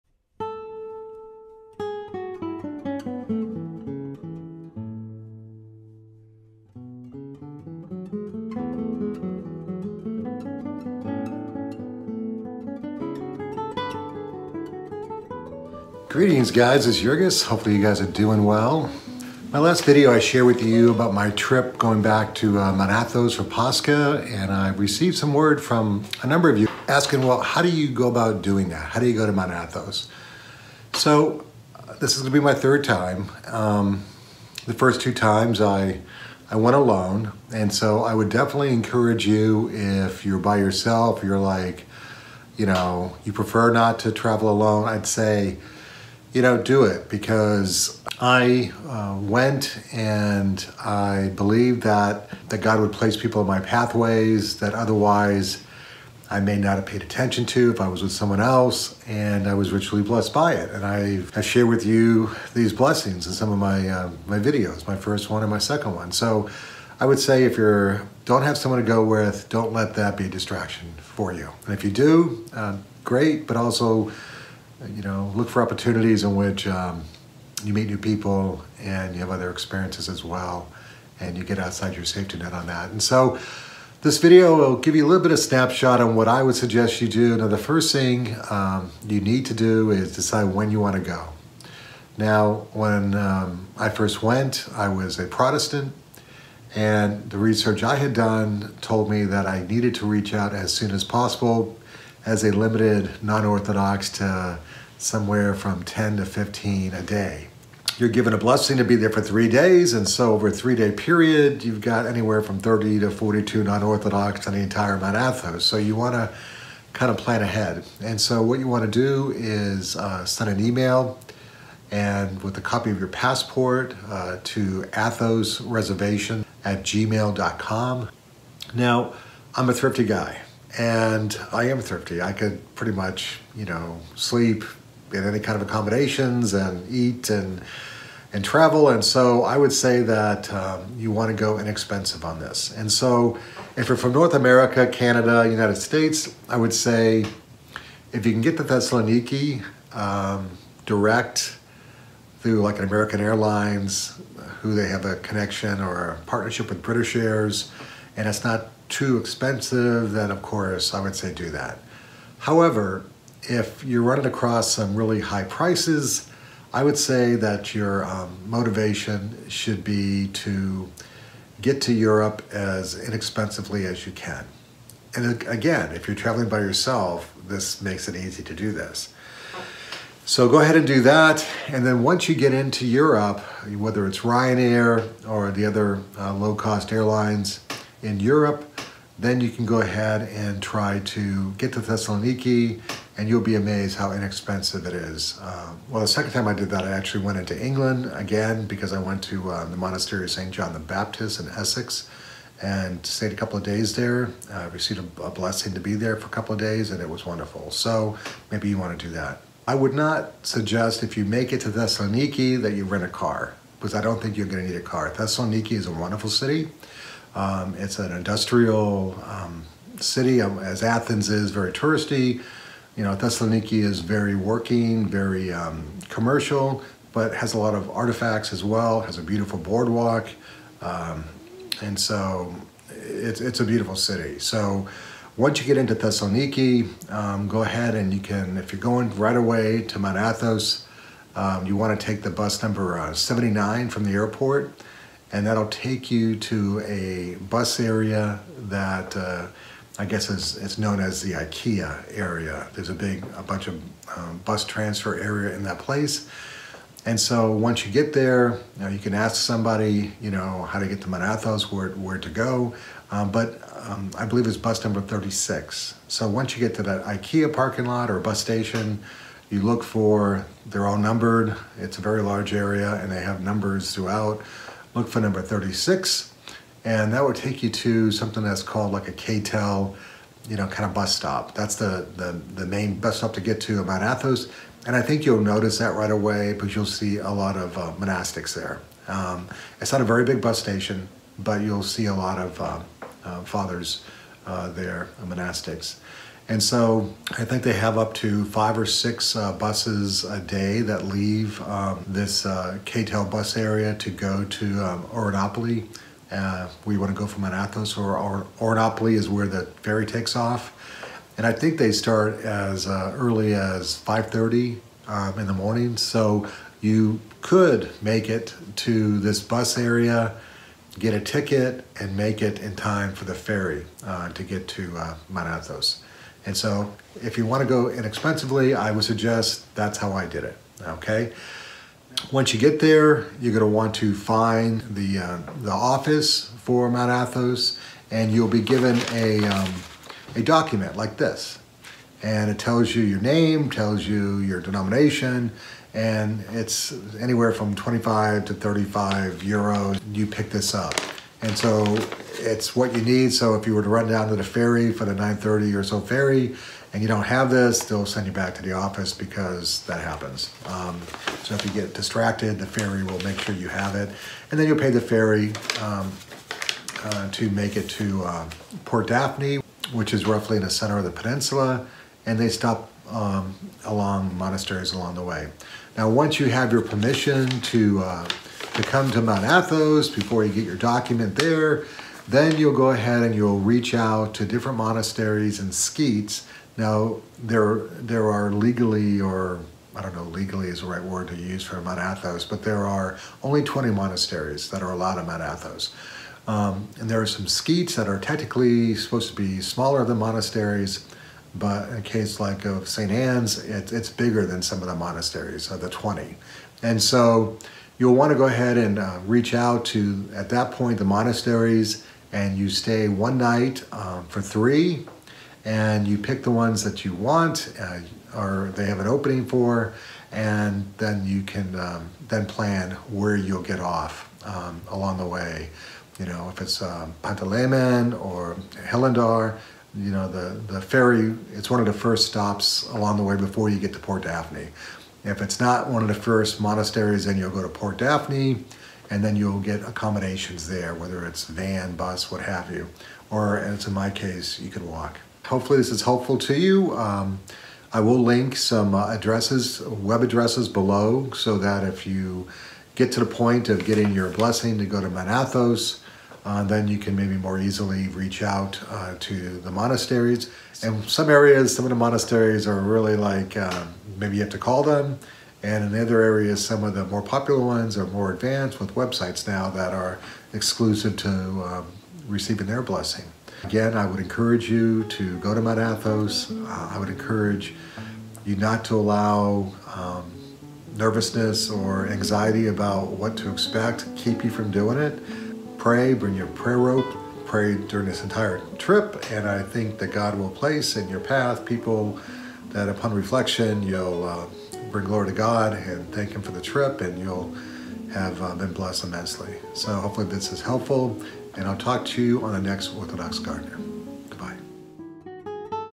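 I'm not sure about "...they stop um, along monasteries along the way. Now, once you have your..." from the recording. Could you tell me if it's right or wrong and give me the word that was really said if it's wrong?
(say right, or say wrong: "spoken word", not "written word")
right.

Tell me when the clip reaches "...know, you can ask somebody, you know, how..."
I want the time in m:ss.
4:18.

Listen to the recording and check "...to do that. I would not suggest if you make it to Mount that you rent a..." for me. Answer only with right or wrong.
wrong.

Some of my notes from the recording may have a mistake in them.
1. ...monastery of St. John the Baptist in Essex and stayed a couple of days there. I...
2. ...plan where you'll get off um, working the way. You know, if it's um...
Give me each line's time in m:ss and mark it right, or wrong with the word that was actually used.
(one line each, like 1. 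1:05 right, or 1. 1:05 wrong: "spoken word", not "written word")
1. 3:19 right
2. 7:02 wrong: "along", not "working".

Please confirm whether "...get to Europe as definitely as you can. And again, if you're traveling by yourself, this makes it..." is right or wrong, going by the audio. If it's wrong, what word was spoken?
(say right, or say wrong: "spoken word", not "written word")
wrong: "inexpensively", not "definitely".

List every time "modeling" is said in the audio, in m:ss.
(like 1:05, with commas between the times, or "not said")
not said.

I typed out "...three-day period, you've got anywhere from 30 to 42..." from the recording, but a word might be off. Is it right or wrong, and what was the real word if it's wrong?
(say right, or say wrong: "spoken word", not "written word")
right.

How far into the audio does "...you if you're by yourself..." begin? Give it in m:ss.
0:39.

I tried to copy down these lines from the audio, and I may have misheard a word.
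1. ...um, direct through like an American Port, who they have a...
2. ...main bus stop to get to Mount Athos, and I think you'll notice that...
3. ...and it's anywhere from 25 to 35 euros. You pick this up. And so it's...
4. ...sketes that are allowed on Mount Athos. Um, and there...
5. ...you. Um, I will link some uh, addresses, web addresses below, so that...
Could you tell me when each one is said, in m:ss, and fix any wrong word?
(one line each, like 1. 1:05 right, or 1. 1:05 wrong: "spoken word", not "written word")
1. 2:29 wrong: "Airlines", not "Port"
2. 4:42 right
3. 5:45 right
4. 6:33 wrong: "monasteries", not "sketes"
5. 7:26 right.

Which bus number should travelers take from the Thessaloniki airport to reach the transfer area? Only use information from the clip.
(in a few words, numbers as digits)
79.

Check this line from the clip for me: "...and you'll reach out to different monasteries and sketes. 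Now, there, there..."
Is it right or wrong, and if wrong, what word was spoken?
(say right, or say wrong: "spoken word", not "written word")
right.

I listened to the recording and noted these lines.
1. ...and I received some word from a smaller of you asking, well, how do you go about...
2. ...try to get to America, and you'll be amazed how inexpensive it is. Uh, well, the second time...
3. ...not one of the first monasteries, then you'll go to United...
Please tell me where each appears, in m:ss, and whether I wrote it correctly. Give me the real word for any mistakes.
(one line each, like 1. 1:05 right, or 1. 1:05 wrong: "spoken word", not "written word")
1. 0:24 wrong: "number", not "smaller"
2. 3:10 wrong: "Thessaloniki", not "America"
3. 7:15 wrong: "Port", not "United".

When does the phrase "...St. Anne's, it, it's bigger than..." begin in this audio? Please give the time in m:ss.
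6:42.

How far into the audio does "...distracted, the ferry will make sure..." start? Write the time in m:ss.
6:01.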